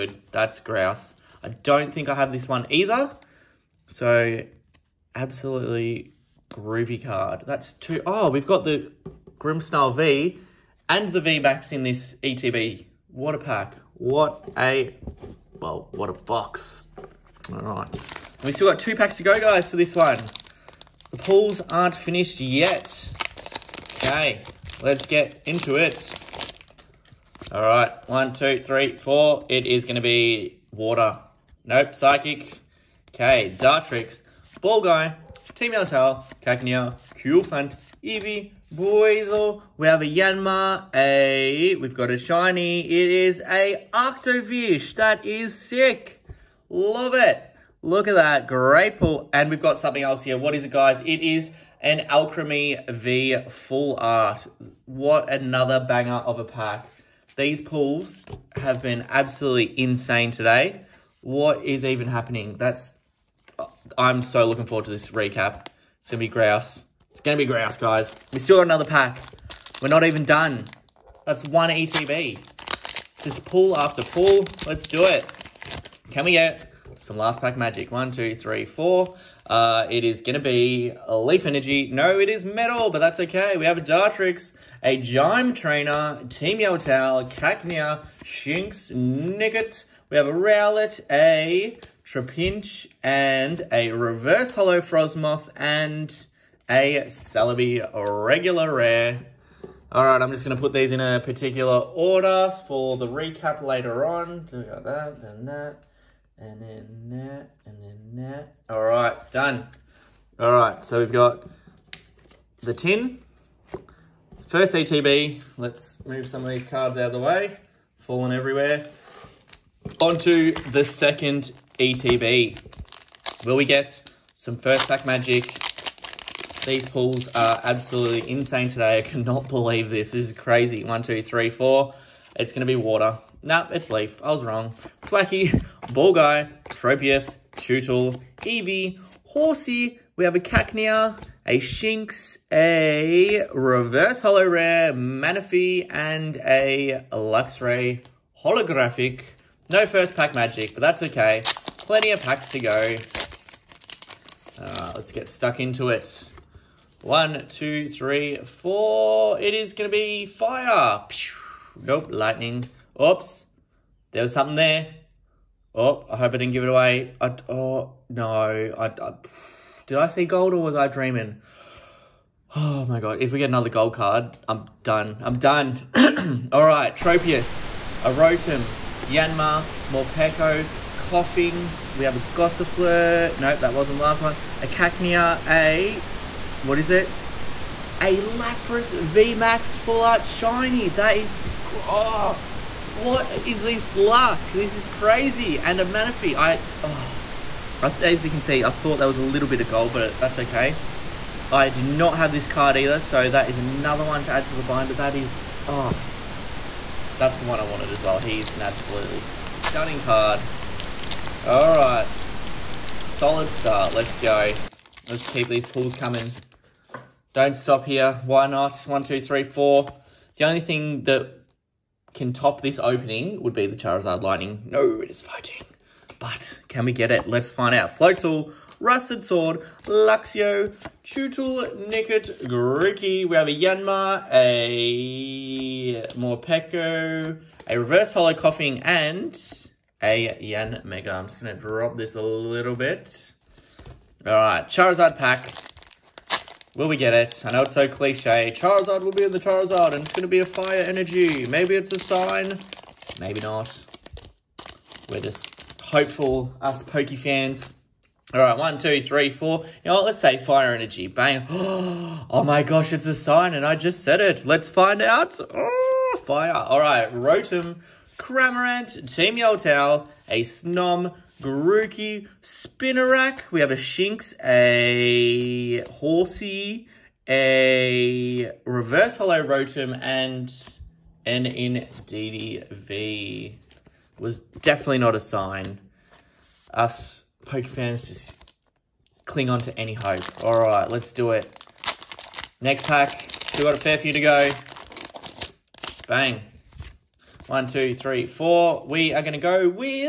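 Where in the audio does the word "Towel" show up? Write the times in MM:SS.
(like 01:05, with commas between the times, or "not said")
01:26, 04:29.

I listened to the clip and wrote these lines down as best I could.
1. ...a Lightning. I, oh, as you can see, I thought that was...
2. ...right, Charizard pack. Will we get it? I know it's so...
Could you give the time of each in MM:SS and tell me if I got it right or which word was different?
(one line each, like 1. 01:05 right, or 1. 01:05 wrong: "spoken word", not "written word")
1. 03:15 wrong: "Manaphy", not "Lightning"
2. 04:04 right.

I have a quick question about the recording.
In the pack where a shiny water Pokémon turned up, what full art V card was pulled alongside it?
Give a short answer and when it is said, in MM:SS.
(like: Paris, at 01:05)
Alcremie V, at 00:52.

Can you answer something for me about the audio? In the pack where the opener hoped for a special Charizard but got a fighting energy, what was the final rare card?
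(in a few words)
Yanmega.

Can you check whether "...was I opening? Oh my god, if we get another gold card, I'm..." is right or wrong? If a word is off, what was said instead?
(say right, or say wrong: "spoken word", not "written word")
wrong: "dreaming", not "opening".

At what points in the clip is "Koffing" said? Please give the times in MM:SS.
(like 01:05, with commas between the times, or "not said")
03:00, 03:58.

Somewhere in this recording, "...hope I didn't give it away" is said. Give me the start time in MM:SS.
02:46.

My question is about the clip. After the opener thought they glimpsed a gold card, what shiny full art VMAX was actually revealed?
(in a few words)
Lapras VMAX.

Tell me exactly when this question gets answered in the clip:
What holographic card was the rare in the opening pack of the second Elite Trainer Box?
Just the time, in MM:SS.
02:27.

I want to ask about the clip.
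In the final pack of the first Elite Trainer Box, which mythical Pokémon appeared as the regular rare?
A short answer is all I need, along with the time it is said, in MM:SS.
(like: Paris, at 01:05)
Celebi, at 01:37.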